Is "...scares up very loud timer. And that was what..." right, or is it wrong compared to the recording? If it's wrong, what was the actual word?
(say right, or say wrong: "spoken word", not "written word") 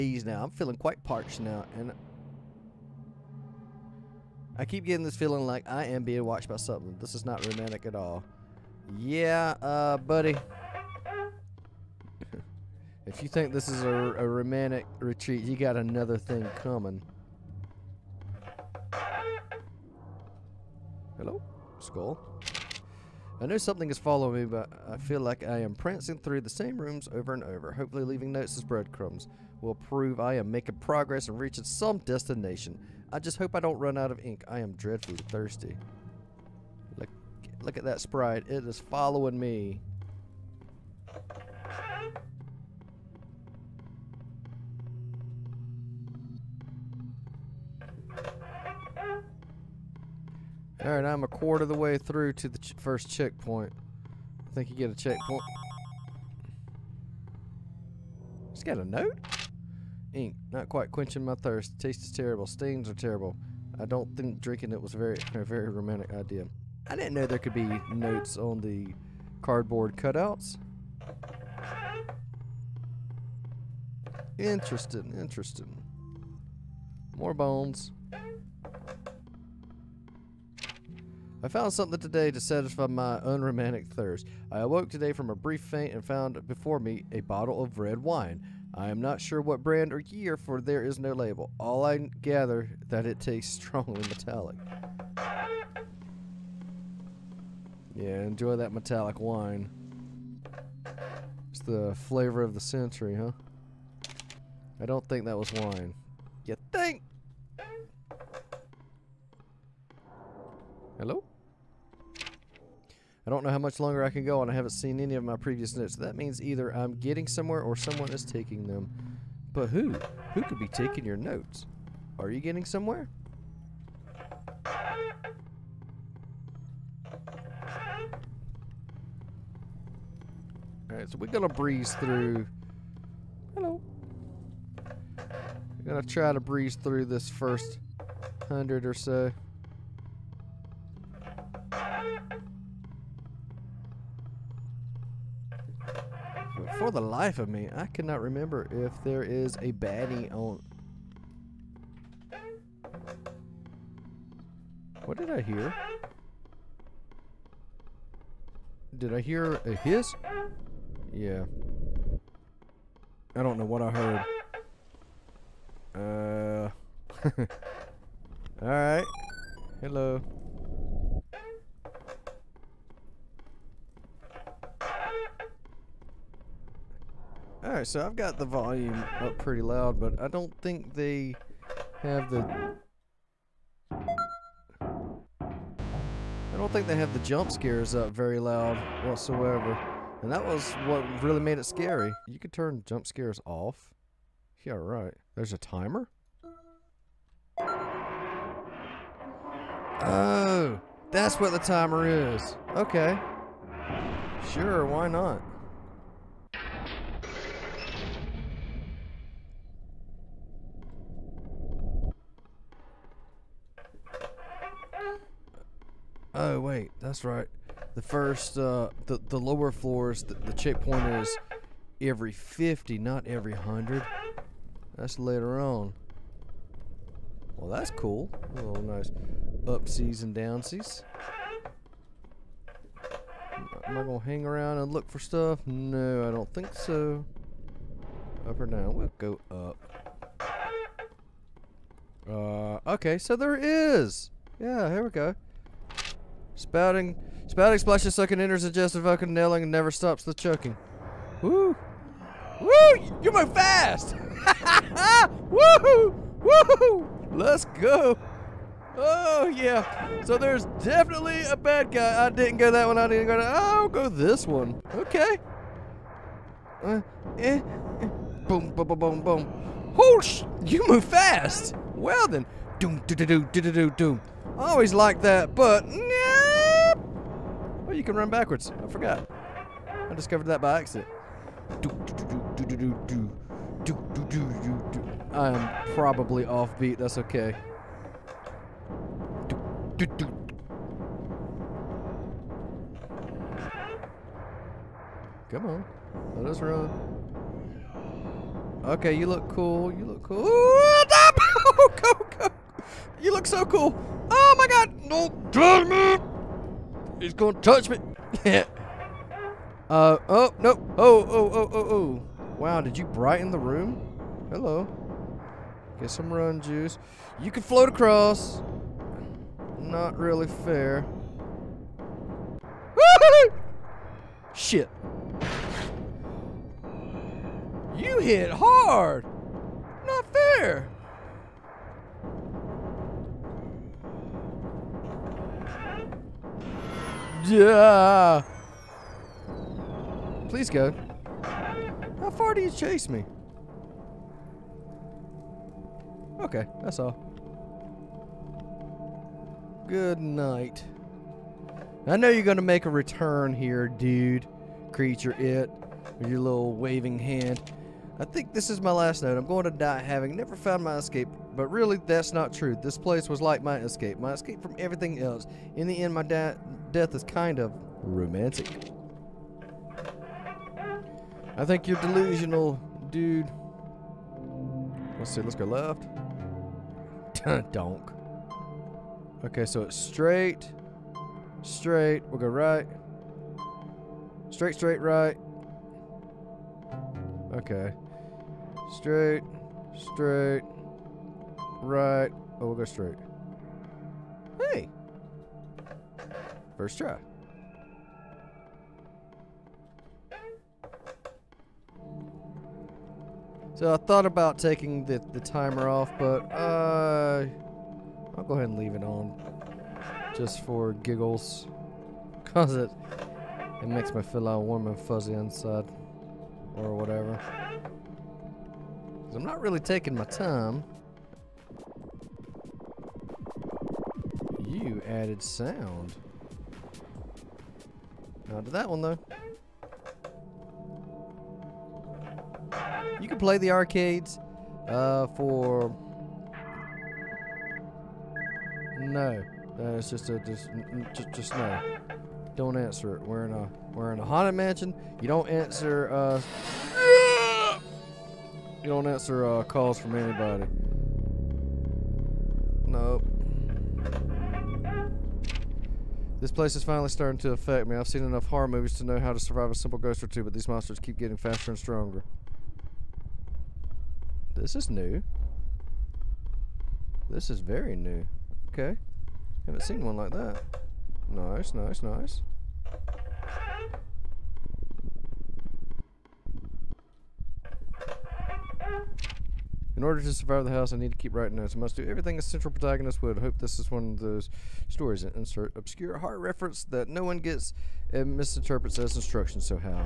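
wrong: "whatsoever", not "timer".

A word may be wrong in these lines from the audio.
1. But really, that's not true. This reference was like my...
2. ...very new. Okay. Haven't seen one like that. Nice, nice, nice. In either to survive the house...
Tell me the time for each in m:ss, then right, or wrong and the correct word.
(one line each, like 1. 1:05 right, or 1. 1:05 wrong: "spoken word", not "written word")
1. 6:01 wrong: "place", not "reference"
2. 7:47 wrong: "order", not "either".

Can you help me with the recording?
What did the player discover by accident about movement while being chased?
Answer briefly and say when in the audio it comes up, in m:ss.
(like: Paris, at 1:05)
Run backwards, at 4:38.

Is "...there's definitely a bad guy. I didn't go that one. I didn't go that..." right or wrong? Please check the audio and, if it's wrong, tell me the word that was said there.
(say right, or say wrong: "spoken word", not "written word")
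right.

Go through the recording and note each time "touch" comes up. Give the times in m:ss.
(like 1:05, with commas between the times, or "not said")
5:07.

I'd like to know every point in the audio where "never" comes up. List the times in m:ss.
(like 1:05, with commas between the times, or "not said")
4:09, 6:00.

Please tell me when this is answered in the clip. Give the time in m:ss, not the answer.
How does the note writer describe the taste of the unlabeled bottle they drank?
1:33.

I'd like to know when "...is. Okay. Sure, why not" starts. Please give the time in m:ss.
3:22.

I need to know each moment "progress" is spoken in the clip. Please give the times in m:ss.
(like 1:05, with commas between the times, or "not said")
0:30.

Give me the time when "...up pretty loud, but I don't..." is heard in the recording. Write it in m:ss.
2:59.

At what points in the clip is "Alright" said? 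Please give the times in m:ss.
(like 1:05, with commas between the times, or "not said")
0:50, 2:10, 2:48, 2:57.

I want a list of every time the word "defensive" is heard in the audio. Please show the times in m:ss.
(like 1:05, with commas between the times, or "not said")
not said.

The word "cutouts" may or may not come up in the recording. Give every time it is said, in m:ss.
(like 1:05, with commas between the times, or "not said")
1:09.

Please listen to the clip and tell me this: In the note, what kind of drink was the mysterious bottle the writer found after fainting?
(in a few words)
Red wine.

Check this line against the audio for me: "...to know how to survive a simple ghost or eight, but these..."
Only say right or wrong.
wrong.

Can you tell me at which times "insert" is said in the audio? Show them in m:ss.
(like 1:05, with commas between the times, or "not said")
8:05.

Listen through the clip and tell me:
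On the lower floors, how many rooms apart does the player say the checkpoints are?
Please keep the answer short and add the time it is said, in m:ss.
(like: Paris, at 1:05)
50, at 3:41.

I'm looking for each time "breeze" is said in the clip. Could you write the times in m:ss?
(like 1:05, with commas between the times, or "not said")
2:11, 2:16.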